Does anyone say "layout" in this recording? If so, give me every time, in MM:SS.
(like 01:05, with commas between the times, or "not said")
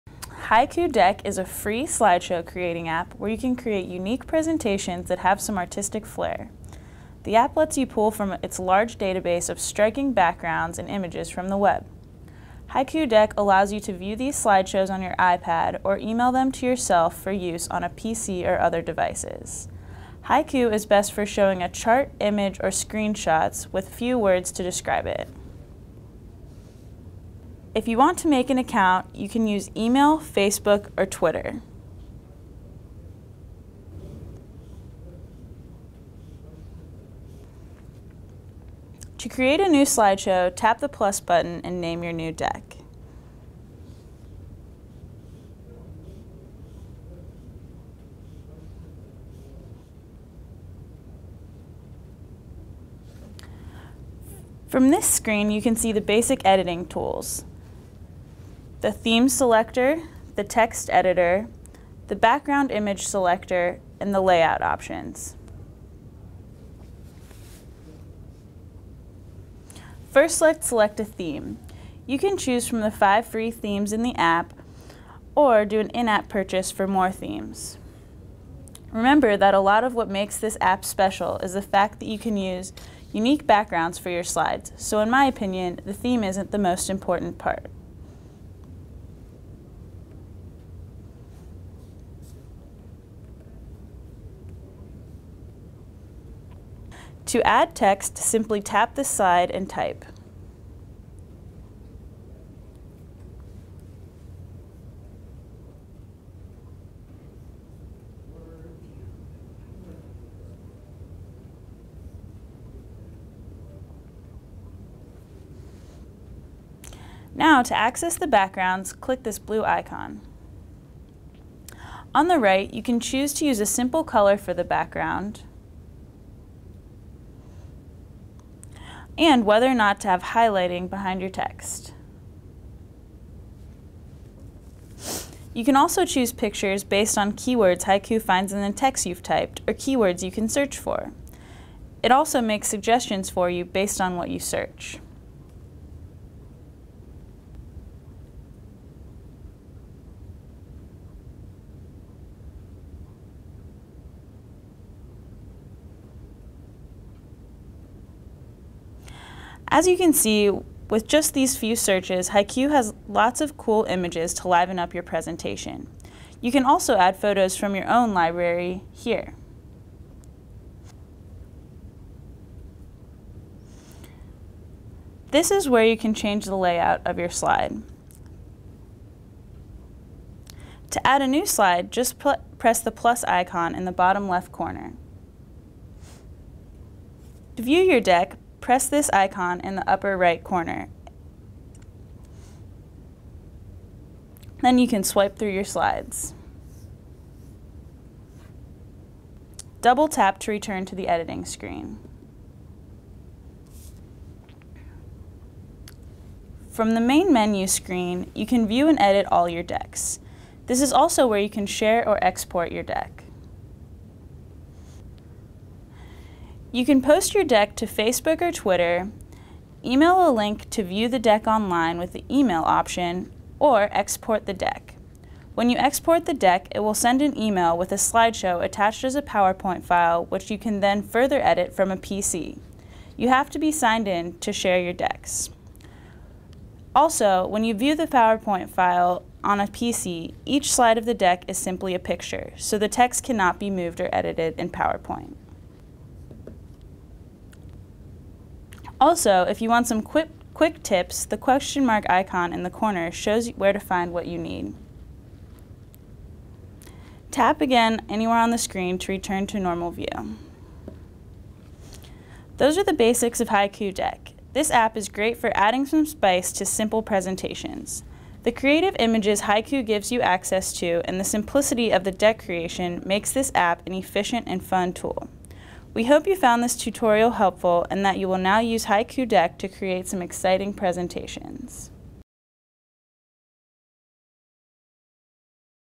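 01:04, 02:56.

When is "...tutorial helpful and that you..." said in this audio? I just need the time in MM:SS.
04:36.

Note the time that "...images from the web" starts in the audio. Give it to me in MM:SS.
00:10.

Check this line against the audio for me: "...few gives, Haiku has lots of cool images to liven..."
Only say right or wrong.
wrong.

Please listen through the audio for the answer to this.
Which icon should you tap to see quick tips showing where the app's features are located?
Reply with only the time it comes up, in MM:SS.
04:11.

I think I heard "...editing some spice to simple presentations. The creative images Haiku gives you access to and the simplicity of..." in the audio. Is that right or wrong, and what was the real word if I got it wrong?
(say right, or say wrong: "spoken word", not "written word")
wrong: "adding", not "editing".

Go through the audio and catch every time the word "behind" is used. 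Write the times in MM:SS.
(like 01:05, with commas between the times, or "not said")
02:10.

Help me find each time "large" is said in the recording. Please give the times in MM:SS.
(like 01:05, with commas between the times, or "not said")
00:08.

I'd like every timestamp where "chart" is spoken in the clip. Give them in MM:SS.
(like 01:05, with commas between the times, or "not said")
00:21.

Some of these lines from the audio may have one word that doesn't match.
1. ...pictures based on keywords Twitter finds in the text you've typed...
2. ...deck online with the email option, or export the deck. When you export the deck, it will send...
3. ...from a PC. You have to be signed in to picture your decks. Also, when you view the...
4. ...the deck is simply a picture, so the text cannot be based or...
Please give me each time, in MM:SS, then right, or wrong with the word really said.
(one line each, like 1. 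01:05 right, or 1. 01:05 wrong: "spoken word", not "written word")
1. 02:16 wrong: "Haiku", not "Twitter"
2. 03:41 right
3. 03:51 wrong: "share", not "picture"
4. 04:01 wrong: "moved", not "based".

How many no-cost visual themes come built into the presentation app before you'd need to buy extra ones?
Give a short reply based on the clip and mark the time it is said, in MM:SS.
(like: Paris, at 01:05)
5, at 01:12.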